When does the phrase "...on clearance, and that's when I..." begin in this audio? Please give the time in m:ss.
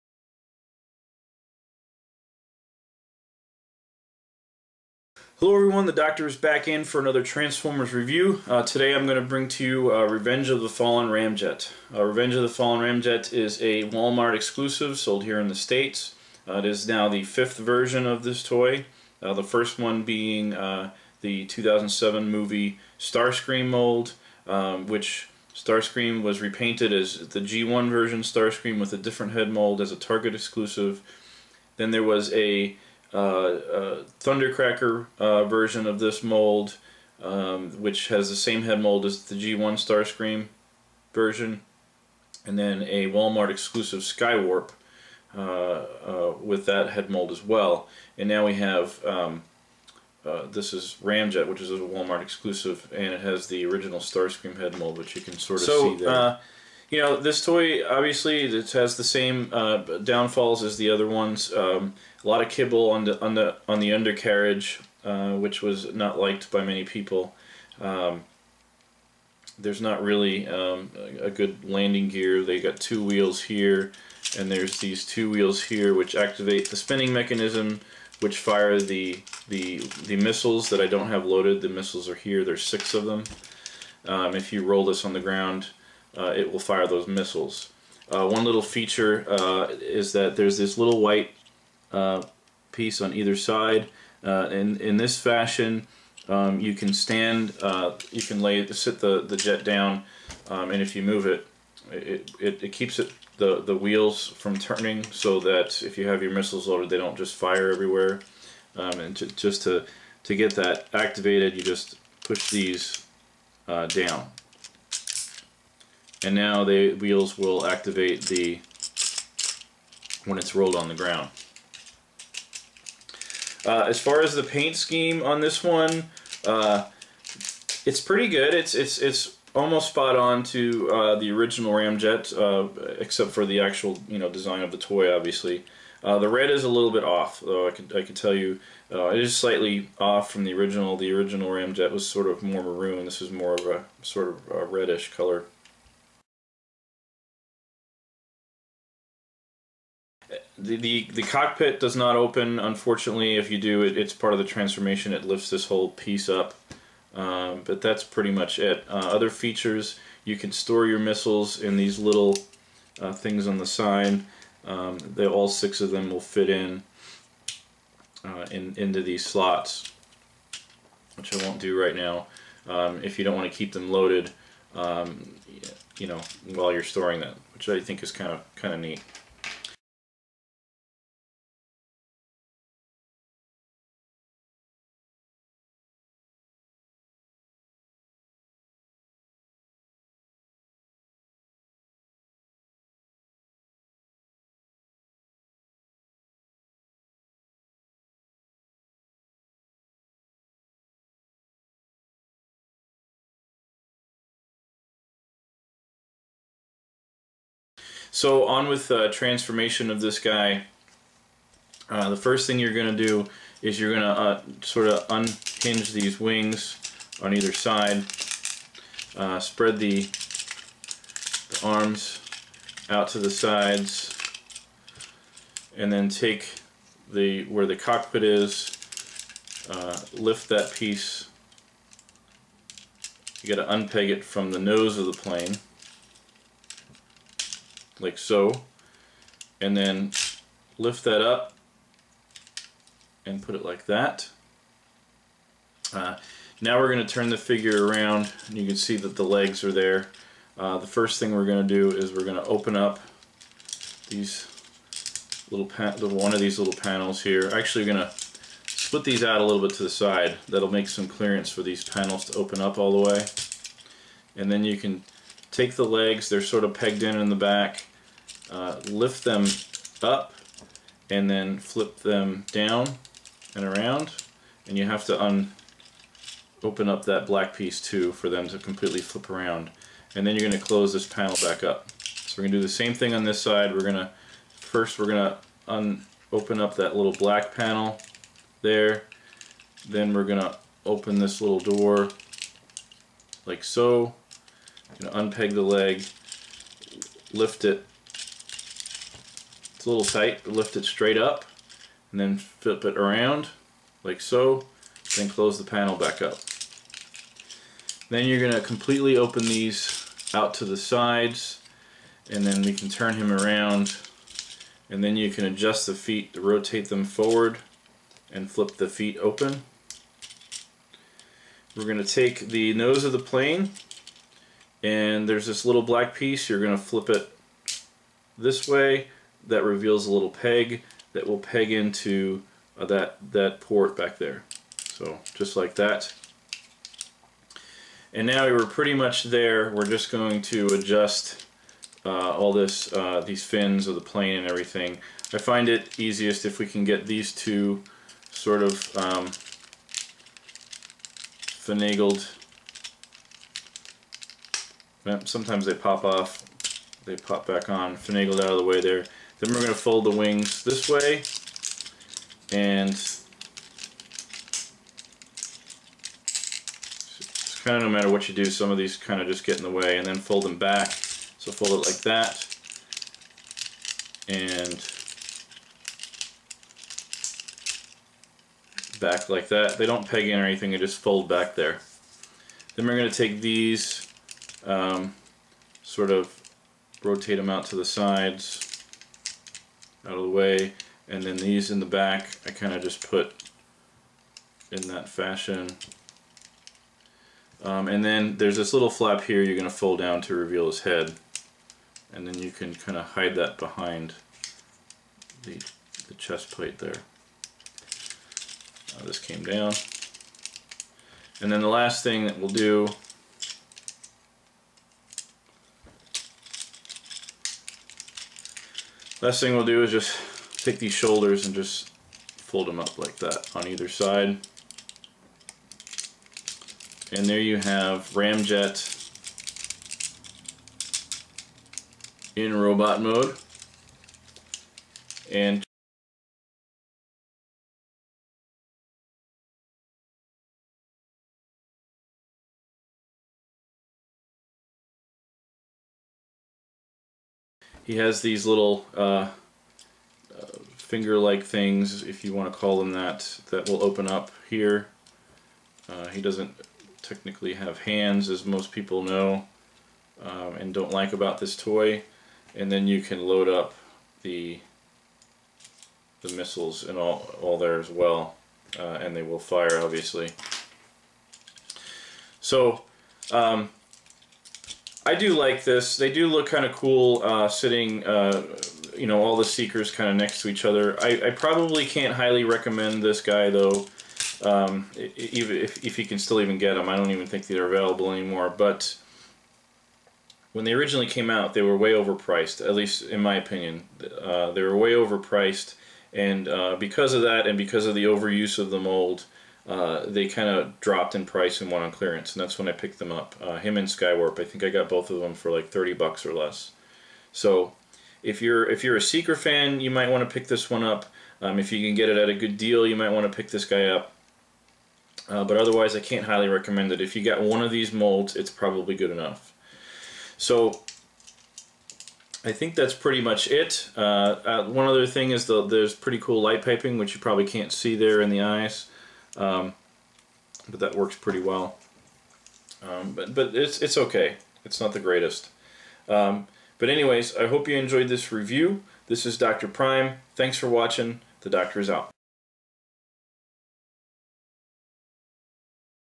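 8:21.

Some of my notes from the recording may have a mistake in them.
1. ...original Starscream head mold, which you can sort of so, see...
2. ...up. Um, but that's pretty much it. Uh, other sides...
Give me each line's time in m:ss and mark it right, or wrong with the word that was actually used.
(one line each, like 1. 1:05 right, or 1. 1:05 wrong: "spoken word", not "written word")
1. 0:53 right
2. 2:36 wrong: "features", not "sides".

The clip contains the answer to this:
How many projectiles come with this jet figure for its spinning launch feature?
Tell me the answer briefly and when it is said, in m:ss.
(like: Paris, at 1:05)
6, at 1:22.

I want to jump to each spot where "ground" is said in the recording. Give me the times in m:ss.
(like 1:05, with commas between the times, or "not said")
1:25, 2:00.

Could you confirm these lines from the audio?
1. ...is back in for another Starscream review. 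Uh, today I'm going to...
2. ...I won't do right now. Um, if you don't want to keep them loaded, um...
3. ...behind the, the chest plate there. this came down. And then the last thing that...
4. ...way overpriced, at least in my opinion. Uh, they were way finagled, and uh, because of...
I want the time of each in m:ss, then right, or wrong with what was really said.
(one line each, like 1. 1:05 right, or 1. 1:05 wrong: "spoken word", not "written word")
1. 0:06 wrong: "Transformers", not "Starscream"
2. 2:51 right
3. 6:43 right
4. 8:11 wrong: "overpriced", not "finagled".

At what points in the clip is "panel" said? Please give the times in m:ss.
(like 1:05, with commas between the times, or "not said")
4:16, 4:21, 4:41, 4:47, 5:05.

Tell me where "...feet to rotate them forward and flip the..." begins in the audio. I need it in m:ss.
5:15.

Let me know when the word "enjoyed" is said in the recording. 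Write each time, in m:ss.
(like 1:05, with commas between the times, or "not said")
8:57.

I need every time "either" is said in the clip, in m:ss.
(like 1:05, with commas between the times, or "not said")
1:33, 3:37, 7:03.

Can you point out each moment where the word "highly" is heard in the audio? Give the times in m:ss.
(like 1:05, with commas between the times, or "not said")
8:02, 8:36.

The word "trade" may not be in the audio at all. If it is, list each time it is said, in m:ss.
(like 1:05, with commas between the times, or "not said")
not said.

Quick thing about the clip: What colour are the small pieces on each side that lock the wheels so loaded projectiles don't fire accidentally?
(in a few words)
White.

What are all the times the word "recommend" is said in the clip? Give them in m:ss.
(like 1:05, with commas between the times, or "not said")
8:02, 8:36.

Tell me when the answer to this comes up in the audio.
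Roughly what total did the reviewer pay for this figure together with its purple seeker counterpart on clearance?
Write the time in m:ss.
8:25.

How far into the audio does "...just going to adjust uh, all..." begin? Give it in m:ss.
5:39.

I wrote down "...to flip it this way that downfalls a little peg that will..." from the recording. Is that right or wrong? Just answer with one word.
wrong.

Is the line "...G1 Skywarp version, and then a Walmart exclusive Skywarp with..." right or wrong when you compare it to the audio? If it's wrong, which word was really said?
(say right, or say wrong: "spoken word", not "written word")
wrong: "Starscream", not "Skywarp".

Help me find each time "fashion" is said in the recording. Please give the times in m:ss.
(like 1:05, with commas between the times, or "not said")
1:35, 6:35.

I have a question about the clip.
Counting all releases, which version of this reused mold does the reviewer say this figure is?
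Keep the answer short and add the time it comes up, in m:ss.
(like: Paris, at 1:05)
5, at 0:17.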